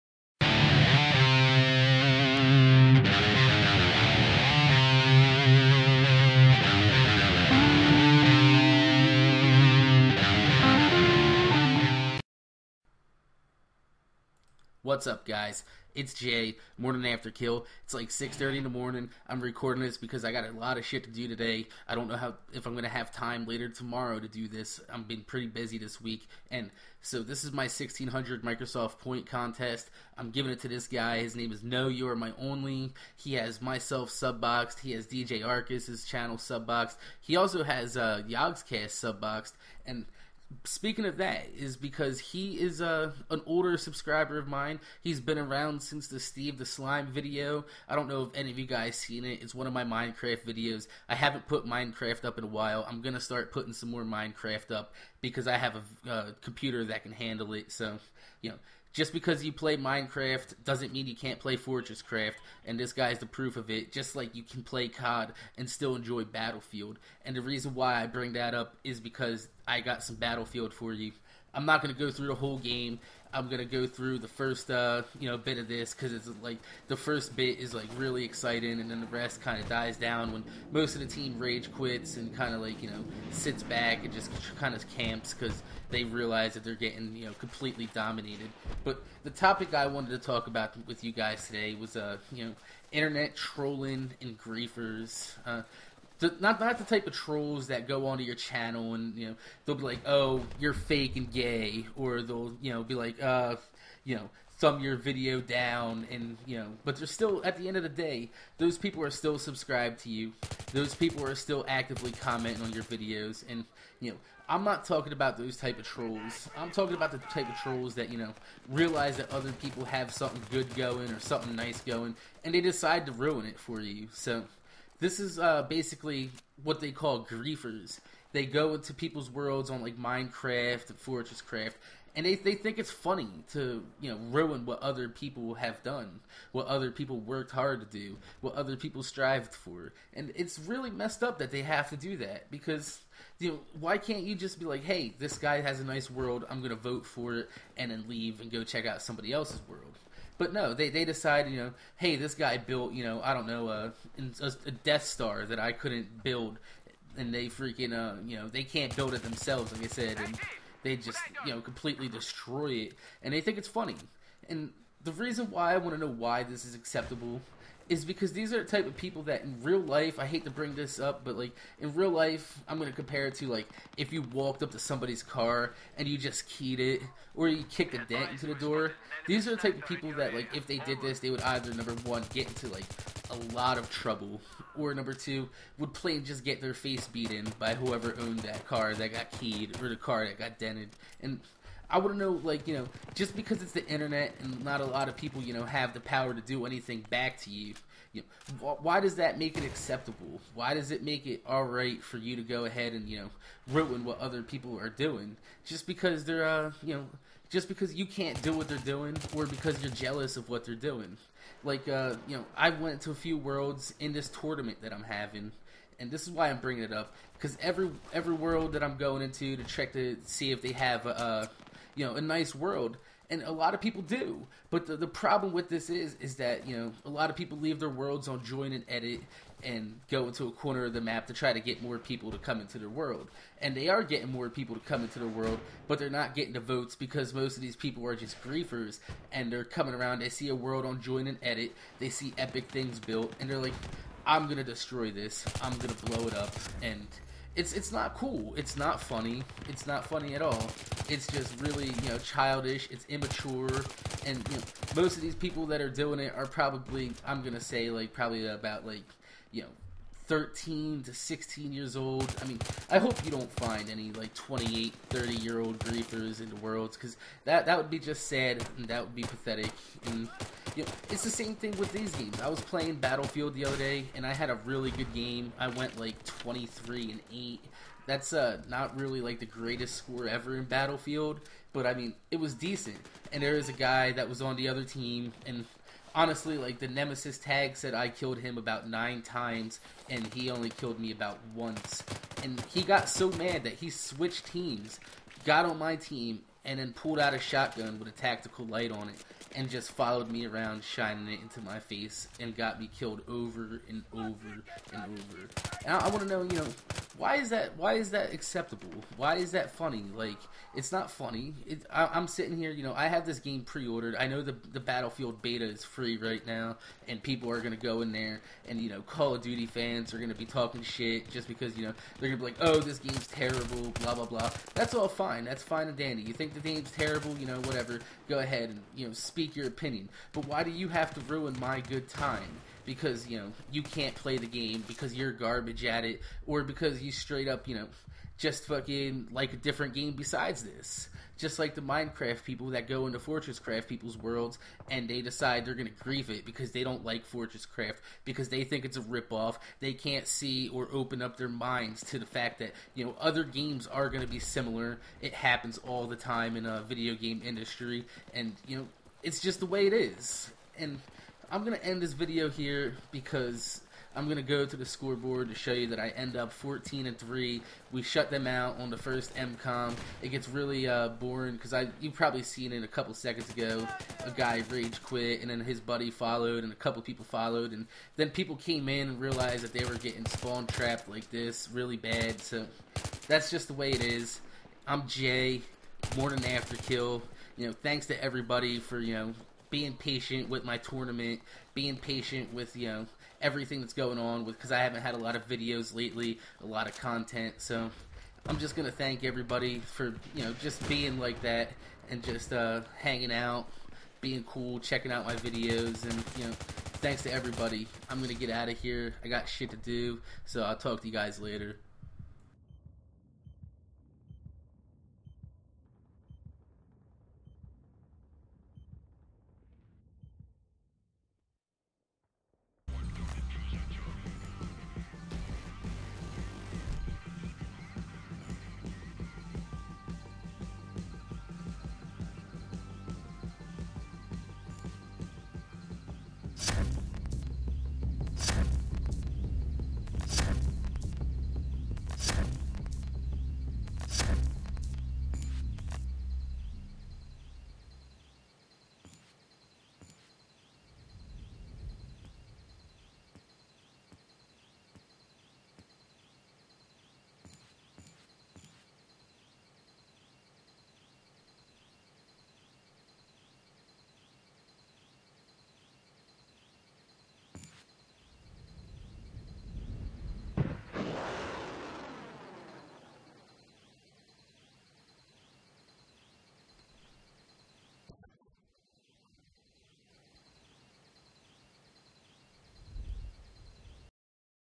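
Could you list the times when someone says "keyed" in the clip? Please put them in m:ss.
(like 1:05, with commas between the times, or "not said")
2:56, 3:09.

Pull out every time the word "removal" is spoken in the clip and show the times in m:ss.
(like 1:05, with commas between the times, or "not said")
not said.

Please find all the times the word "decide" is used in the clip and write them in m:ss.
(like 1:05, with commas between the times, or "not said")
2:02, 2:31, 5:45.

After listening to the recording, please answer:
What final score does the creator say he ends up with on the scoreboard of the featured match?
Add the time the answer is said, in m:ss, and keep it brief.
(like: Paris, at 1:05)
14 and 3, at 6:06.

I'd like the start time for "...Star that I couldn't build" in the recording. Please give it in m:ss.
2:35.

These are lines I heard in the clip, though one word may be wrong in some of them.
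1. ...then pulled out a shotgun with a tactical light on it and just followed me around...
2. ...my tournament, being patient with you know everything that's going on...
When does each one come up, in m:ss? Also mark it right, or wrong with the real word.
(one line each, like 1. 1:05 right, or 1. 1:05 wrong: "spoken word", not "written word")
1. 4:56 right
2. 6:30 right.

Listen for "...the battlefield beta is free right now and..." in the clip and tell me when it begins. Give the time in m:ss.
5:14.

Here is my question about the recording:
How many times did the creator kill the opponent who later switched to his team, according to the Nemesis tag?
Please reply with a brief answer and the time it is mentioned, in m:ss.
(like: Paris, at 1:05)
9, at 4:48.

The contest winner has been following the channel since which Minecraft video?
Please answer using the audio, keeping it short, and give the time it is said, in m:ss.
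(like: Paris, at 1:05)
Steve the Slime, at 0:46.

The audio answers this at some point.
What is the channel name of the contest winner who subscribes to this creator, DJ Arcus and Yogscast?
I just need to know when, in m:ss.
0:31.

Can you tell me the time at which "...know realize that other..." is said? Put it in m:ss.
1:58.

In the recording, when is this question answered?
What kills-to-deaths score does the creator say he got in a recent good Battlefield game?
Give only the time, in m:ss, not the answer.
4:36.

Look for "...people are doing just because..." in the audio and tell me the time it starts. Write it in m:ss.
3:24.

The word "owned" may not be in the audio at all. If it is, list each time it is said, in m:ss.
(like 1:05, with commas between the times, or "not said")
3:08.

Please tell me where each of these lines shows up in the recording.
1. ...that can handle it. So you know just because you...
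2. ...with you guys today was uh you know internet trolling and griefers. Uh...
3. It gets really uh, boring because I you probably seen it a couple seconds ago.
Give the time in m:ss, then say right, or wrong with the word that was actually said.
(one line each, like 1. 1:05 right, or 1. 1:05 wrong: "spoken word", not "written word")
1. 0:56 right
2. 1:30 right
3. 6:10 right.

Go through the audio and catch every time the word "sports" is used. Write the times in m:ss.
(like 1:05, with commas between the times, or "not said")
not said.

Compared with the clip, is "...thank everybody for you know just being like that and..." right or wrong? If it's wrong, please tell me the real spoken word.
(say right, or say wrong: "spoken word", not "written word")
right.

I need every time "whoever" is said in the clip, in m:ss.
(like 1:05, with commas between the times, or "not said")
3:07.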